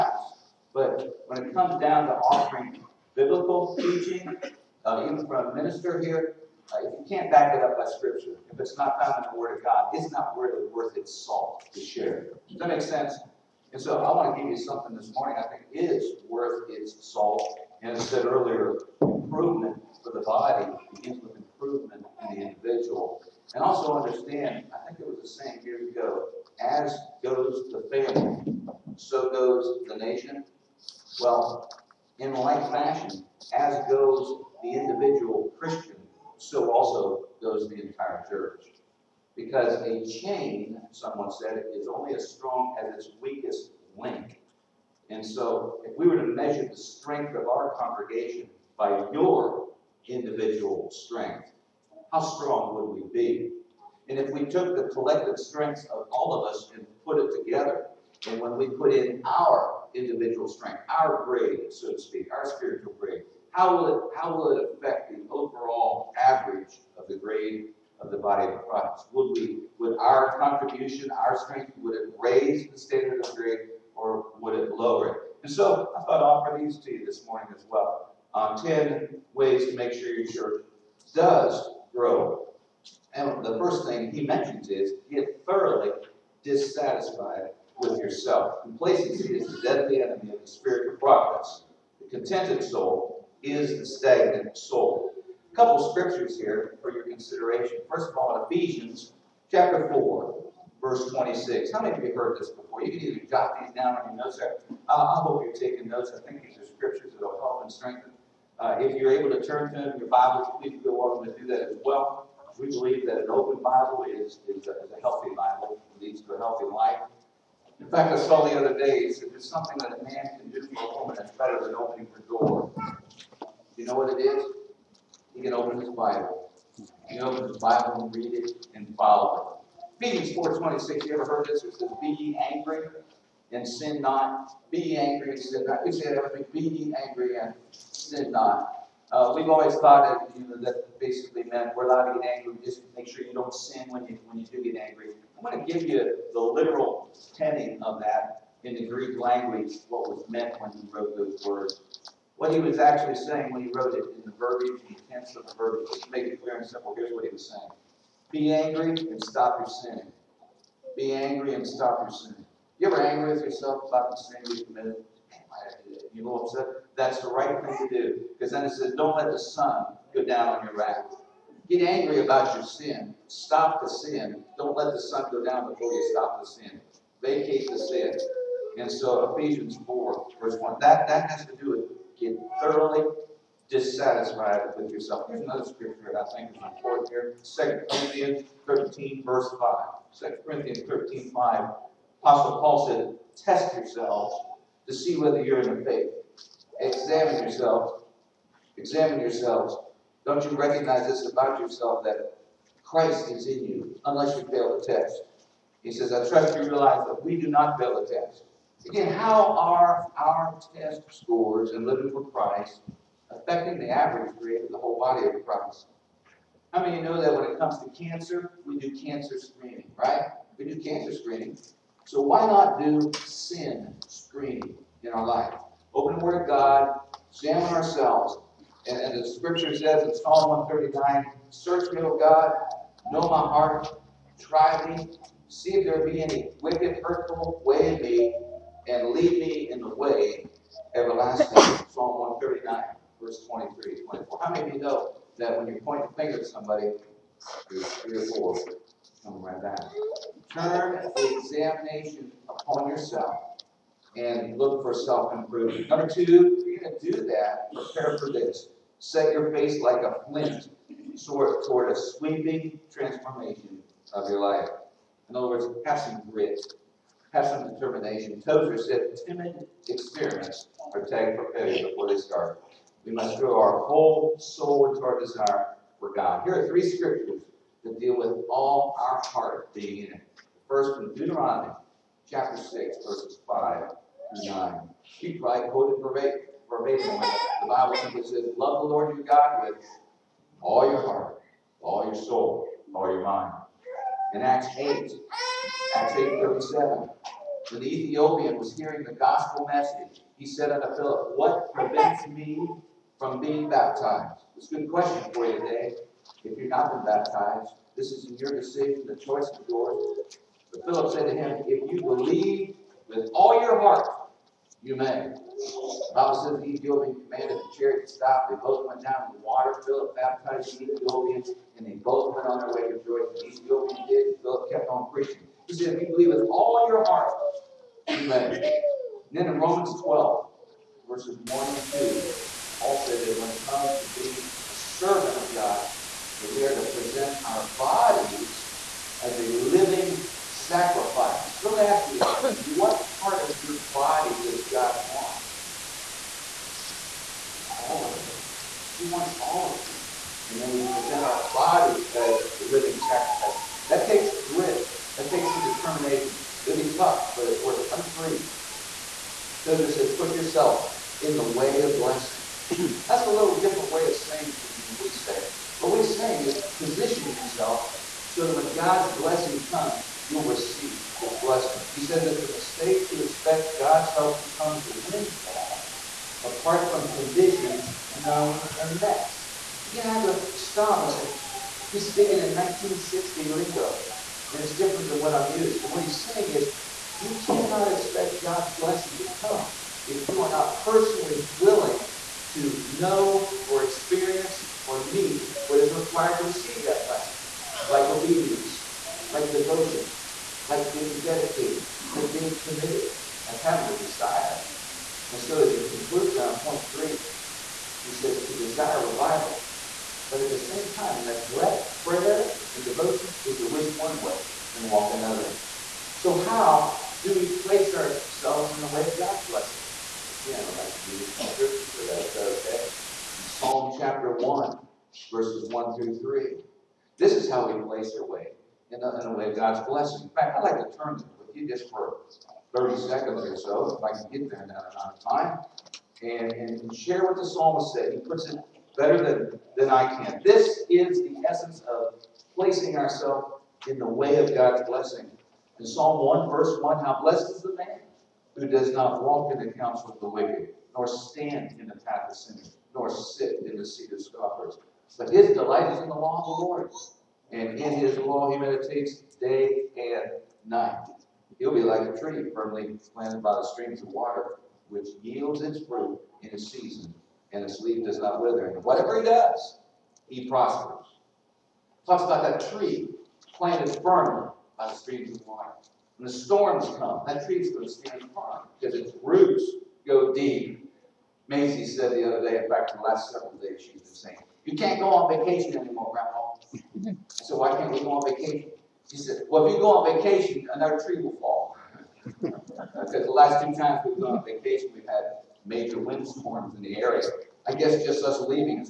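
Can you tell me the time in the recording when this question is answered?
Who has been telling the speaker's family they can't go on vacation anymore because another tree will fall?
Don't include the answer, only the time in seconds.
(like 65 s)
481 s.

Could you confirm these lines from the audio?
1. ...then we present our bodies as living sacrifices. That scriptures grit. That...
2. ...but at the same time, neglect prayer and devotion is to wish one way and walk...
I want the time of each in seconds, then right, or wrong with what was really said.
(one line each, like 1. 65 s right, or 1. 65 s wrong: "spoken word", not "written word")
1. 350 s wrong: "takes", not "scriptures"
2. 410 s right.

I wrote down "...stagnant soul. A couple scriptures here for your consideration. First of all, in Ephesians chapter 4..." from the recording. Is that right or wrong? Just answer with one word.
right.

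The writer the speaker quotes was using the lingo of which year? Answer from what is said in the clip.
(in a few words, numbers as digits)
1960.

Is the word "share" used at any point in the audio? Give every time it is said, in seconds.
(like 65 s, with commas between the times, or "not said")
11 s, 436 s.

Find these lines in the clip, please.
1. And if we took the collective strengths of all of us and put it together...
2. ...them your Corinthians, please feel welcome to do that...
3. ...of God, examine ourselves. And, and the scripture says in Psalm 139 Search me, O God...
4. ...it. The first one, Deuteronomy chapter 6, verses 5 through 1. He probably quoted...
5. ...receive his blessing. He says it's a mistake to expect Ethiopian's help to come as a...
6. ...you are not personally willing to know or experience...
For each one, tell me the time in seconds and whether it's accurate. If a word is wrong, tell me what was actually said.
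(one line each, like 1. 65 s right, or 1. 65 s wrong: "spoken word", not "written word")
1. 54 s right
2. 109 s wrong: "Bibles", not "Corinthians"
3. 226 s right
4. 280 s wrong: "9", not "1"
5. 370 s wrong: "God", not "Ethiopian"
6. 390 s right.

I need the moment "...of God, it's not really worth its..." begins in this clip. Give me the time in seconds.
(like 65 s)
9 s.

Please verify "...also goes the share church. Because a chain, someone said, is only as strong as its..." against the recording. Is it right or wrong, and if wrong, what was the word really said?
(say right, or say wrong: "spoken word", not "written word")
wrong: "entire", not "share".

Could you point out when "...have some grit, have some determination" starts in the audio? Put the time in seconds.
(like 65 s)
265 s.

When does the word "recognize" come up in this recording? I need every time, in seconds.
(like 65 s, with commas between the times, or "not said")
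200 s.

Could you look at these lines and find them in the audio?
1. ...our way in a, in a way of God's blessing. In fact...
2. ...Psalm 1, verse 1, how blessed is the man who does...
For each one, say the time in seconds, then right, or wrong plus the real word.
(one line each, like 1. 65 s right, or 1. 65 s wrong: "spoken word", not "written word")
1. 428 s right
2. 445 s right.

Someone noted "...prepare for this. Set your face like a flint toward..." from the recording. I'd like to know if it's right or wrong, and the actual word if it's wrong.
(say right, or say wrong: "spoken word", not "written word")
right.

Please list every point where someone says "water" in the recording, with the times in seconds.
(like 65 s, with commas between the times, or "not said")
319 s, 464 s, 475 s.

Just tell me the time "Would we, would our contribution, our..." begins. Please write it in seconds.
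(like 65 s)
69 s.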